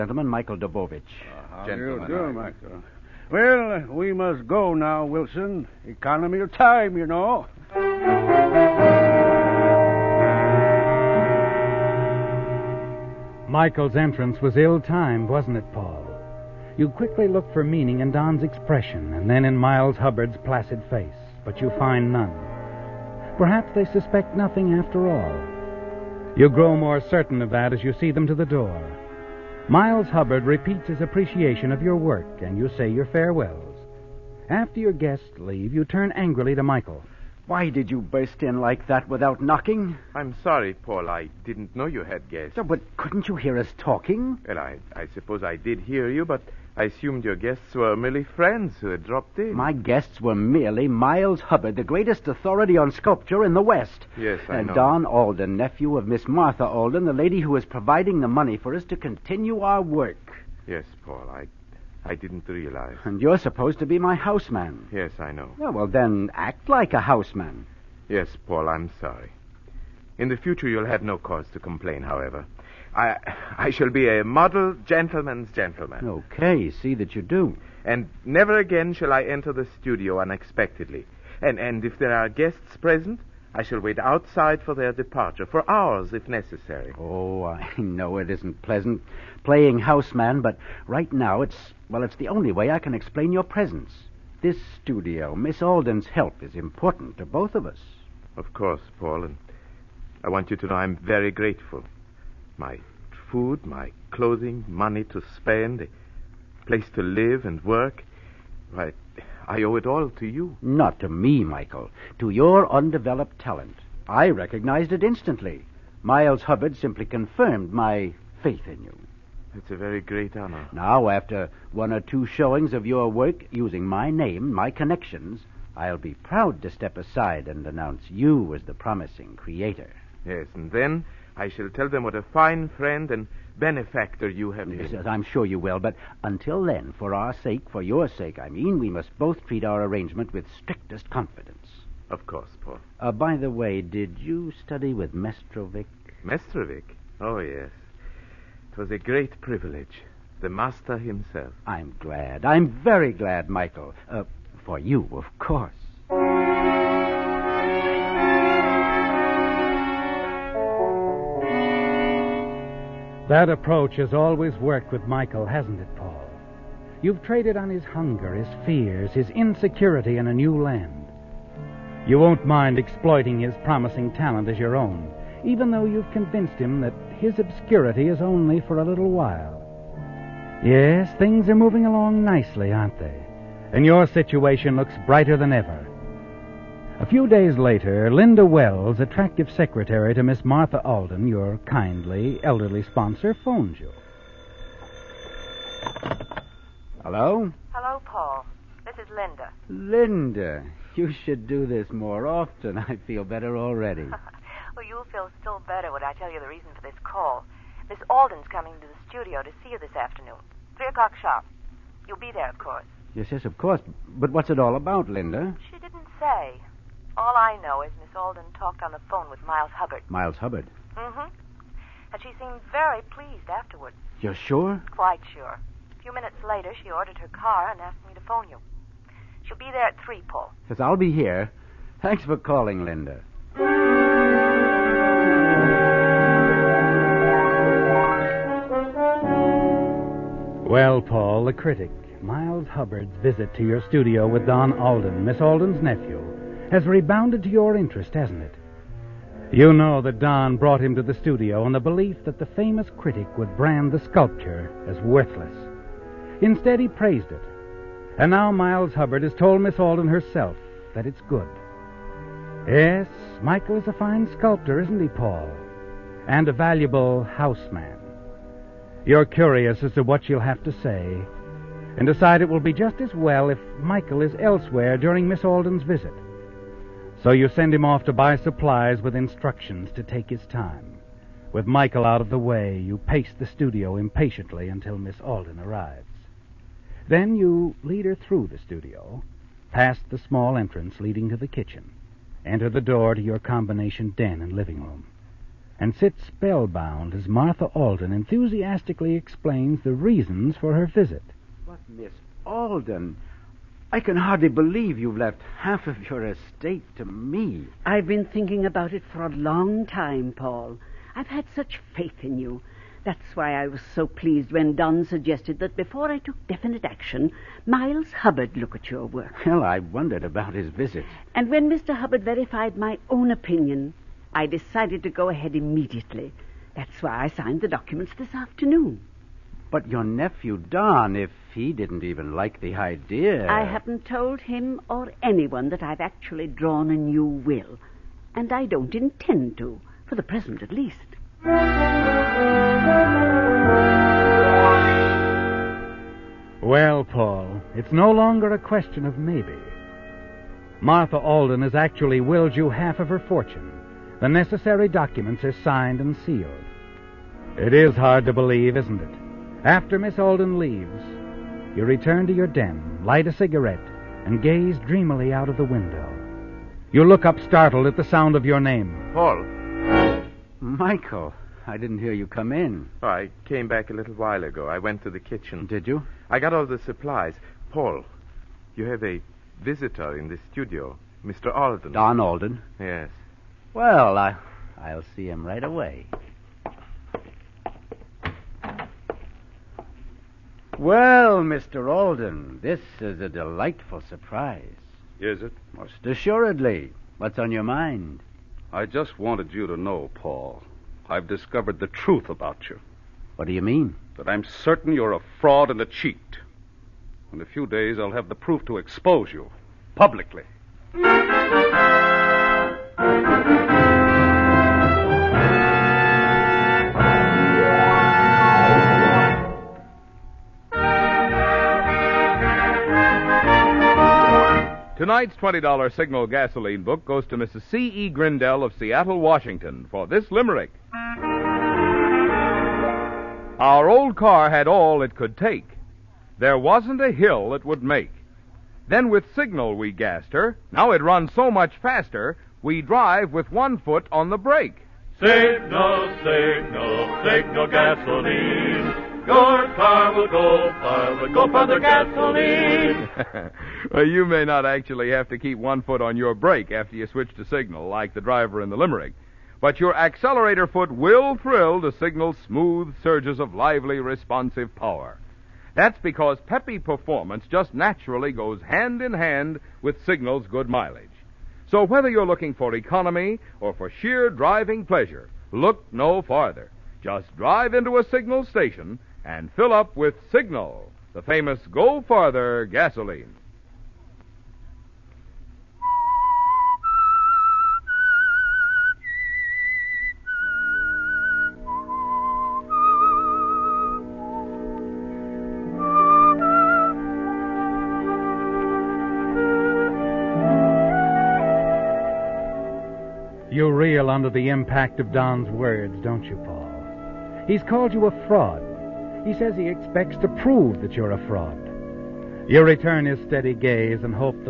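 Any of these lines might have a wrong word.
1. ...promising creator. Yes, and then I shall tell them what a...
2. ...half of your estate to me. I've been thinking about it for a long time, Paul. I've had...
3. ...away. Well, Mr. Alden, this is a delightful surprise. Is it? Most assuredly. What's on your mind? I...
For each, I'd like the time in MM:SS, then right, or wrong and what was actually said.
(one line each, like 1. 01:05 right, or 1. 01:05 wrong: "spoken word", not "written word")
1. 02:08 right
2. 05:05 right
3. 06:25 right.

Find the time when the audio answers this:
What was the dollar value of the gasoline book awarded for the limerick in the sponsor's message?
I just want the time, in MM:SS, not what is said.
07:05.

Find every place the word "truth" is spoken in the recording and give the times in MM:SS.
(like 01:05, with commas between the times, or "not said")
06:41.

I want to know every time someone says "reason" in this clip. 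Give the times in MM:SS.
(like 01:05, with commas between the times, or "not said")
03:26, 04:59.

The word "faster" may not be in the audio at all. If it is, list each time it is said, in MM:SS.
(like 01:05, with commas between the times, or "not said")
07:21.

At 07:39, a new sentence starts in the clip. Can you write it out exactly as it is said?
But your accelerator foot will thrill to signal smooth surges of lively, responsive power.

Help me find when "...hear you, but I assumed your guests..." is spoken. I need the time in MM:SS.
00:45.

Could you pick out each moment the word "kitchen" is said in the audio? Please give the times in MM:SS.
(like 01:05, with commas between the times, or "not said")
04:51, 06:15.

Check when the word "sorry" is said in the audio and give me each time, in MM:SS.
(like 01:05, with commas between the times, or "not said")
00:40, 01:08.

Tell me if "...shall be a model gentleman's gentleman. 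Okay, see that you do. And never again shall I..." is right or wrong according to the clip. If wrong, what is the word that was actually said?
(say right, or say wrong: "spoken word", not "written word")
right.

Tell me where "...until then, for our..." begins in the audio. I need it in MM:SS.
02:16.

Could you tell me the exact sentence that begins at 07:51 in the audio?
So whether you're looking for economy or for sheer driving pleasure, look no farther.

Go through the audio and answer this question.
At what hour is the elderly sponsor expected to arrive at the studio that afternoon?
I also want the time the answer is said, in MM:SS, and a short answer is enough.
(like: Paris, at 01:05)
3 o'clock, at 03:30.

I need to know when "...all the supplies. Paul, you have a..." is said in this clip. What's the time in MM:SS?
06:16.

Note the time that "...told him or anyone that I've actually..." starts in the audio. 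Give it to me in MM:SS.
05:34.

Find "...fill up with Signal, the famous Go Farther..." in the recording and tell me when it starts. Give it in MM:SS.
07:59.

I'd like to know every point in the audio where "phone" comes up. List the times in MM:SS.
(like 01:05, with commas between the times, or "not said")
03:13, 03:39, 03:48.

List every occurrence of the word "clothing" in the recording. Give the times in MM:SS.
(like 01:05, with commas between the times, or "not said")
01:44.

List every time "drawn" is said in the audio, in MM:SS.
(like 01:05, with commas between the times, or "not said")
05:36.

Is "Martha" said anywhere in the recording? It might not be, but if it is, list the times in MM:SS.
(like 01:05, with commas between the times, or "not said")
00:56, 03:10, 04:57, 05:50.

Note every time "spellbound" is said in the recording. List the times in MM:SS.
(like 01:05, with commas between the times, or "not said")
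04:56.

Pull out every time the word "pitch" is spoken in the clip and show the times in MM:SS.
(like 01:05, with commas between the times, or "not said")
not said.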